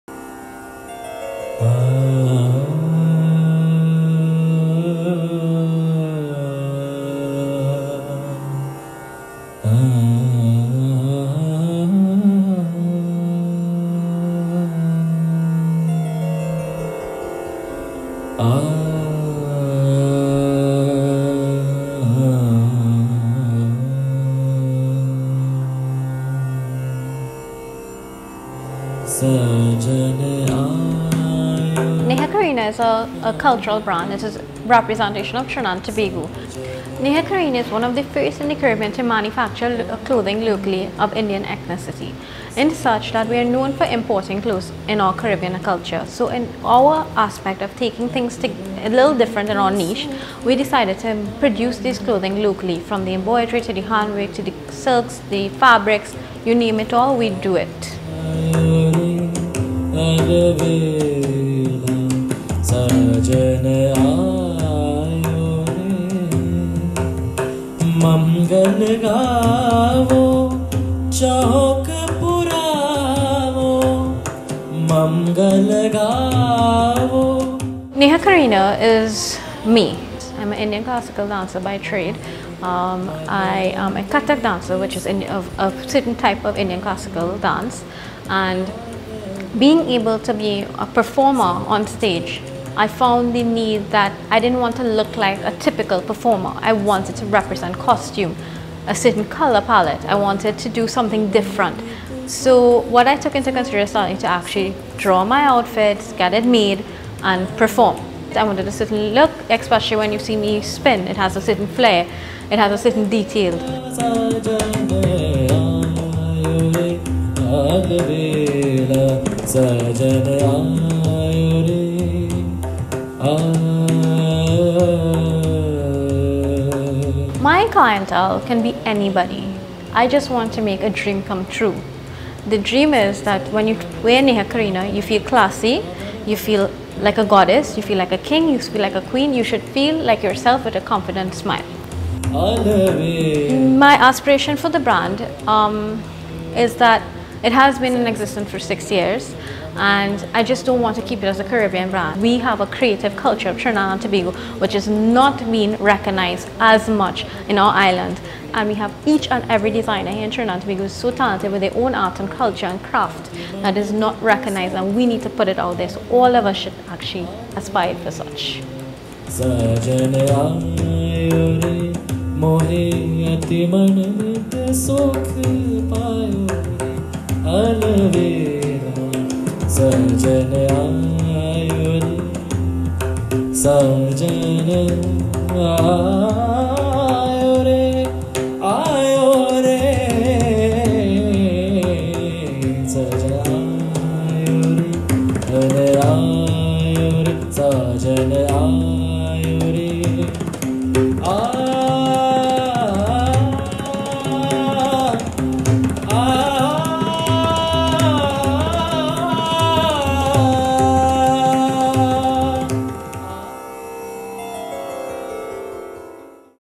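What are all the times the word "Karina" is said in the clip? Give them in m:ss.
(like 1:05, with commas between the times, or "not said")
0:32, 0:37, 1:18, 2:14.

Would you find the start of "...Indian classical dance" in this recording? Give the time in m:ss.
1:26.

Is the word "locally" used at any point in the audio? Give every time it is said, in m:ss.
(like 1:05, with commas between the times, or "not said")
0:40, 0:52.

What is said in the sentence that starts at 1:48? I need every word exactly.
I wanted a certain look, especially when you see me spin.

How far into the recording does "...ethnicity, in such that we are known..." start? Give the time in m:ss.
0:41.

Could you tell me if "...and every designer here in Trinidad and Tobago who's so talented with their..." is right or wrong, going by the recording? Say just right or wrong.
right.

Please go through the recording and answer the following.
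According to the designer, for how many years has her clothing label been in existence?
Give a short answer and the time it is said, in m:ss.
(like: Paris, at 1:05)
6, at 2:28.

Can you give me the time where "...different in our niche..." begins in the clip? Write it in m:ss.
0:49.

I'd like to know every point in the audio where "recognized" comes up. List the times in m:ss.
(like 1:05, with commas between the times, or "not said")
2:35, 2:44.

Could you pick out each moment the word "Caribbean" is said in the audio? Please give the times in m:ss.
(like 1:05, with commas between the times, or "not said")
0:38, 0:45, 2:31.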